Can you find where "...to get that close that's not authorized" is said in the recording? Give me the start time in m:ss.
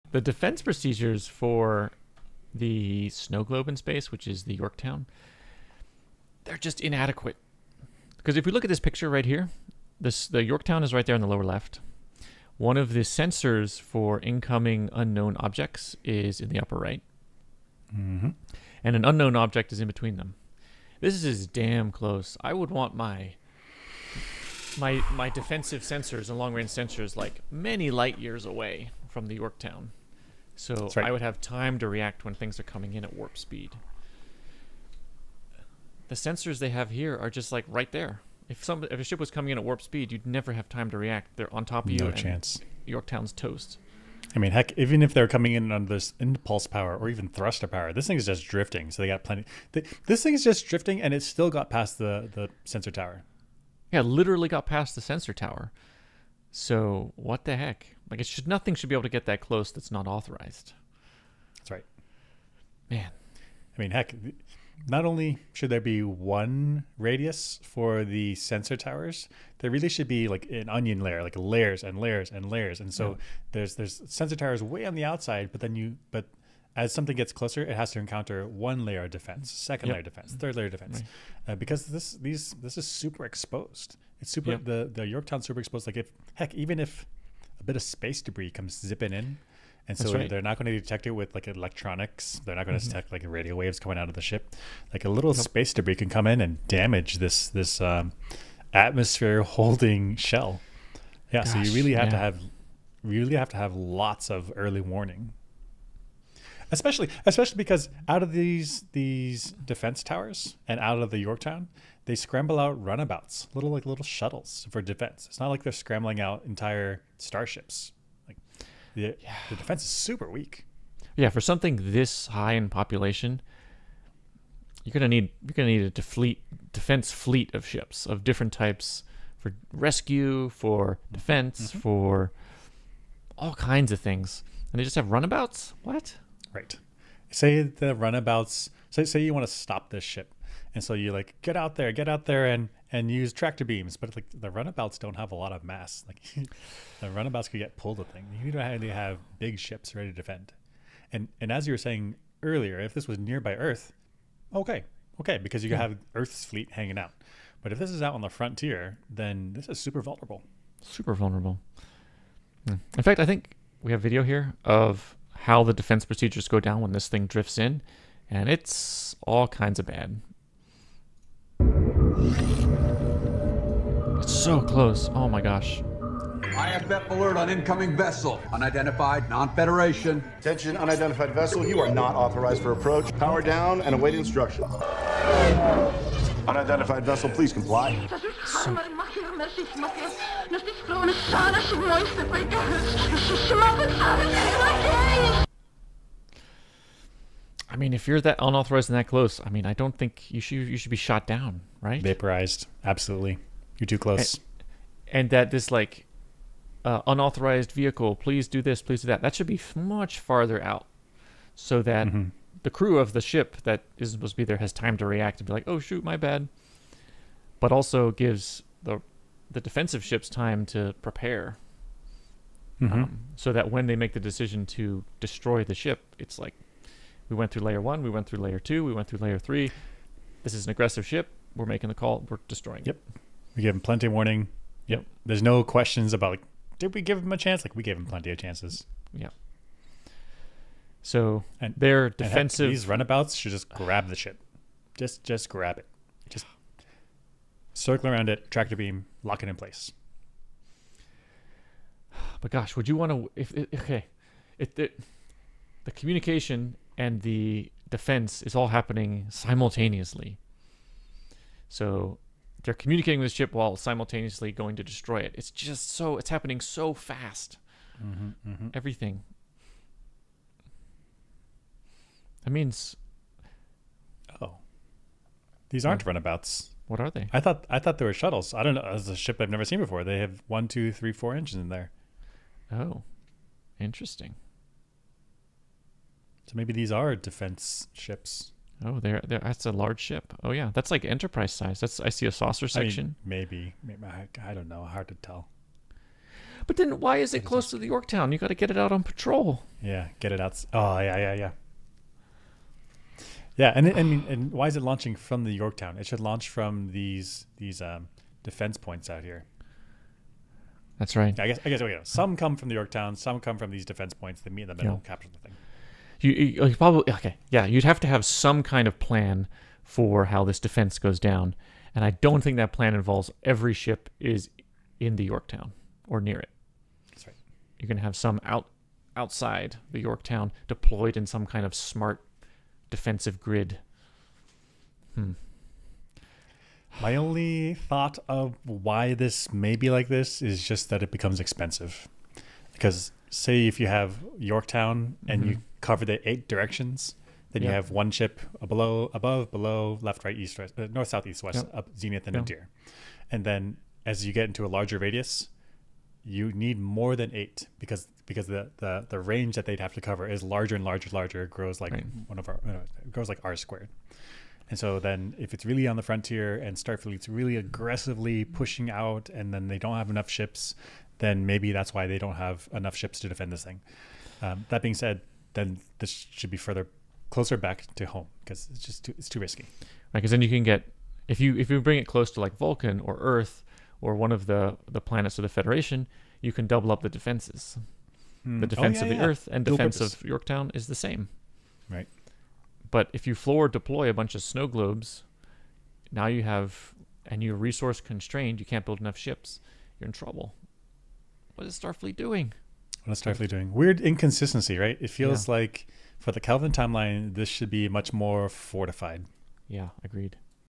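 0:59.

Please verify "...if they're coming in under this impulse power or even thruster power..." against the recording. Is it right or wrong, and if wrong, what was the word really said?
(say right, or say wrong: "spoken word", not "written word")
right.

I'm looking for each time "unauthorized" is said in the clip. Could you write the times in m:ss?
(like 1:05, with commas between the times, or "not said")
3:18, 3:27.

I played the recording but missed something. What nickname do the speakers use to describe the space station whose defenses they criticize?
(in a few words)
snow globe in space.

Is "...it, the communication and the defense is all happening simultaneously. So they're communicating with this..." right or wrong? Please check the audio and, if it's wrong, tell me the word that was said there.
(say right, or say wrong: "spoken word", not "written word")
right.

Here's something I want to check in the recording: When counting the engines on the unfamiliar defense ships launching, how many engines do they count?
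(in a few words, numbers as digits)
4.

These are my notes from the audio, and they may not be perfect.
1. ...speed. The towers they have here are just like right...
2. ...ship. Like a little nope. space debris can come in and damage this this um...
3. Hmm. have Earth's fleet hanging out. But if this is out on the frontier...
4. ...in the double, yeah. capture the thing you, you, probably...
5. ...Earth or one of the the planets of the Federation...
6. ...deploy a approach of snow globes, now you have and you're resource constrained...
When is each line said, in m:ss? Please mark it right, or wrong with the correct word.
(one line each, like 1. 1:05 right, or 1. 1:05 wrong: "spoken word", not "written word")
1. 0:33 wrong: "sensors", not "towers"
2. 1:34 right
3. 2:35 right
4. 5:14 wrong: "middle", not "double"
5. 6:23 right
6. 6:33 wrong: "bunch", not "approach".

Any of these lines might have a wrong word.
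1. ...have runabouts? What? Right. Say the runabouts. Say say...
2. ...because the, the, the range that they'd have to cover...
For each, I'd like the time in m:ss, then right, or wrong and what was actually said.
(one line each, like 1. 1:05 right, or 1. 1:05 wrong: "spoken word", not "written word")
1. 2:14 right
2. 5:58 right.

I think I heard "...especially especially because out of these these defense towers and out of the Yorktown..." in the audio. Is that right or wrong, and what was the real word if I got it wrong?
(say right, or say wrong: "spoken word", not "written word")
right.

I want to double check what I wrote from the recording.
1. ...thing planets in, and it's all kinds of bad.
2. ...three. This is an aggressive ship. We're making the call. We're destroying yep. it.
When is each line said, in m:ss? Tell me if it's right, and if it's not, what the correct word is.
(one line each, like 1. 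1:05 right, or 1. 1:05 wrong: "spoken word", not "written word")
1. 2:47 wrong: "drifts", not "planets"
2. 3:49 right.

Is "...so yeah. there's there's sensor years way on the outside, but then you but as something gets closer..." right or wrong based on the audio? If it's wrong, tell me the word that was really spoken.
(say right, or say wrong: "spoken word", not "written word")
wrong: "towers", not "years".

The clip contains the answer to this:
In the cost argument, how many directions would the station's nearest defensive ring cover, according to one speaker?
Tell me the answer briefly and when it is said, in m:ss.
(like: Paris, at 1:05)
8, at 5:46.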